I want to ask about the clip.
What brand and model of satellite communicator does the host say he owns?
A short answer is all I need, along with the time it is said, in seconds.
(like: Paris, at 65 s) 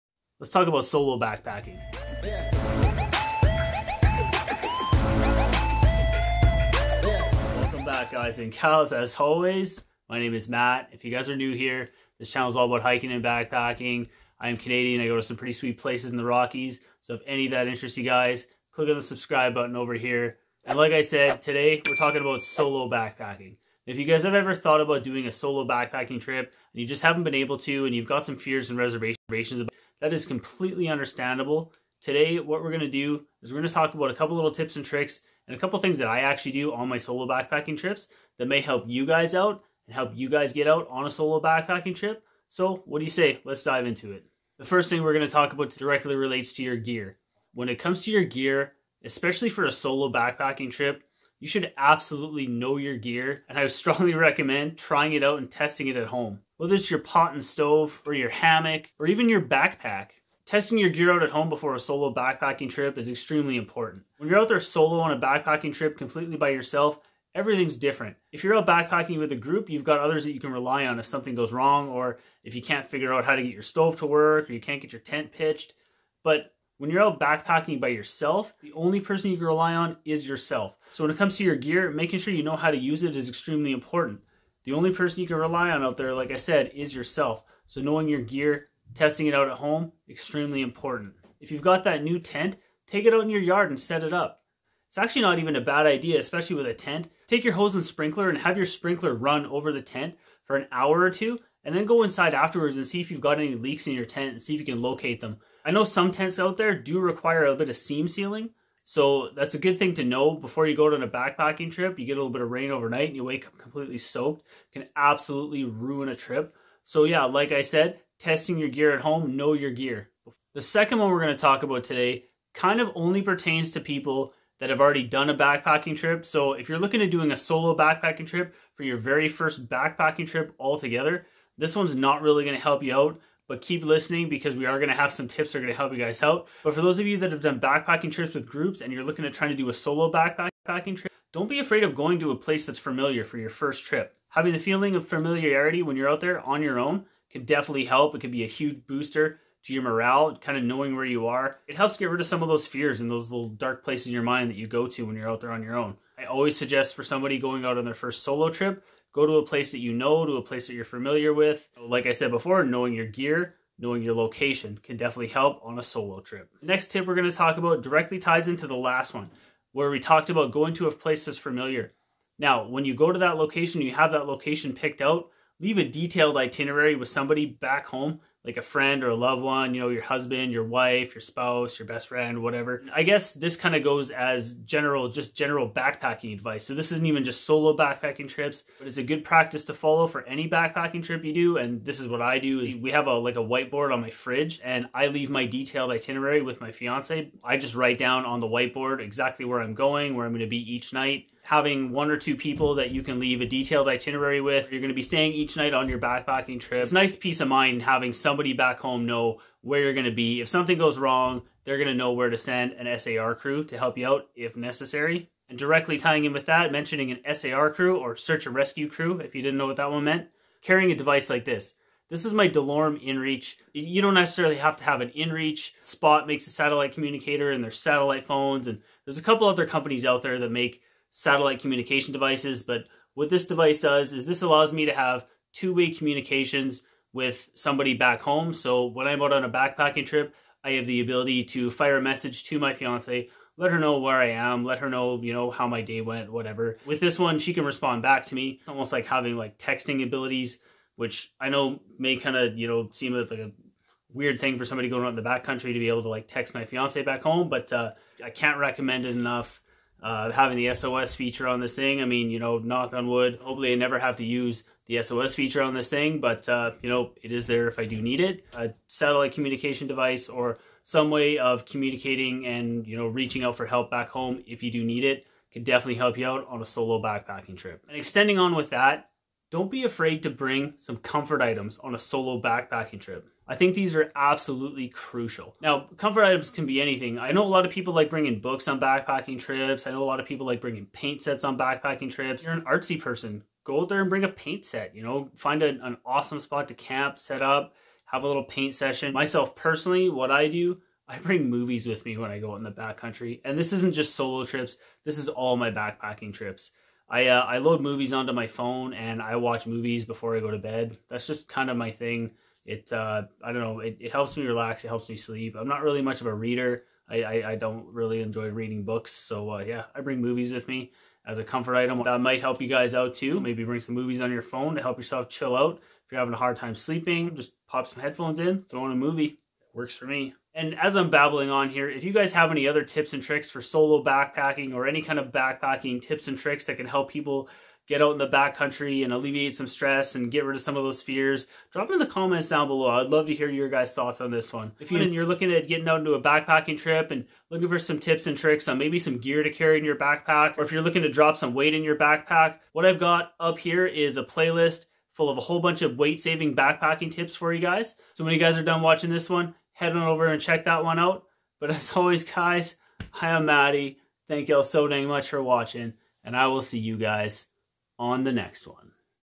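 DeLorme InReach, at 222 s.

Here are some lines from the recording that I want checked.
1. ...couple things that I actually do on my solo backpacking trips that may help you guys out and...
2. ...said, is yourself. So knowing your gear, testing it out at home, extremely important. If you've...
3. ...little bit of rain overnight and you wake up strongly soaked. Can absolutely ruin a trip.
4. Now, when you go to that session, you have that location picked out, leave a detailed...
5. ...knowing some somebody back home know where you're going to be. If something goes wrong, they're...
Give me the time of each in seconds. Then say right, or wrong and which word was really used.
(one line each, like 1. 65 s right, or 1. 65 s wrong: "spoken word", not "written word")
1. 35 s right
2. 86 s right
3. 112 s wrong: "completely", not "strongly"
4. 172 s wrong: "location", not "session"
5. 207 s wrong: "having", not "knowing".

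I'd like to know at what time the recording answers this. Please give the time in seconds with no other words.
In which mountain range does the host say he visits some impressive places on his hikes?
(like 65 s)
16 s.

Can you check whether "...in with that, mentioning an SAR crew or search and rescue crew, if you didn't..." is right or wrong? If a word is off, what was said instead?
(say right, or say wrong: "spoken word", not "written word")
right.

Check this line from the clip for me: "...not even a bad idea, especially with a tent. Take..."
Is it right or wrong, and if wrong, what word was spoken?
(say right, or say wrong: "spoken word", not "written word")
right.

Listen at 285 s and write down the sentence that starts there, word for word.
Now, comfort items can be anything.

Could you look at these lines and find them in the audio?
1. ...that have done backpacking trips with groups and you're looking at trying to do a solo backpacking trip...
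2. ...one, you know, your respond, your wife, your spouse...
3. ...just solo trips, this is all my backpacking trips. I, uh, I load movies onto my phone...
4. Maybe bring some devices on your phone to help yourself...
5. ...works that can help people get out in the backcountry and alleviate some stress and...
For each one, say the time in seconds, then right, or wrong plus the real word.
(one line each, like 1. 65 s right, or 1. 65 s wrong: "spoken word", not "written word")
1. 137 s right
2. 179 s wrong: "husband", not "respond"
3. 303 s right
4. 323 s wrong: "movies", not "devices"
5. 336 s wrong: "tricks", not "works".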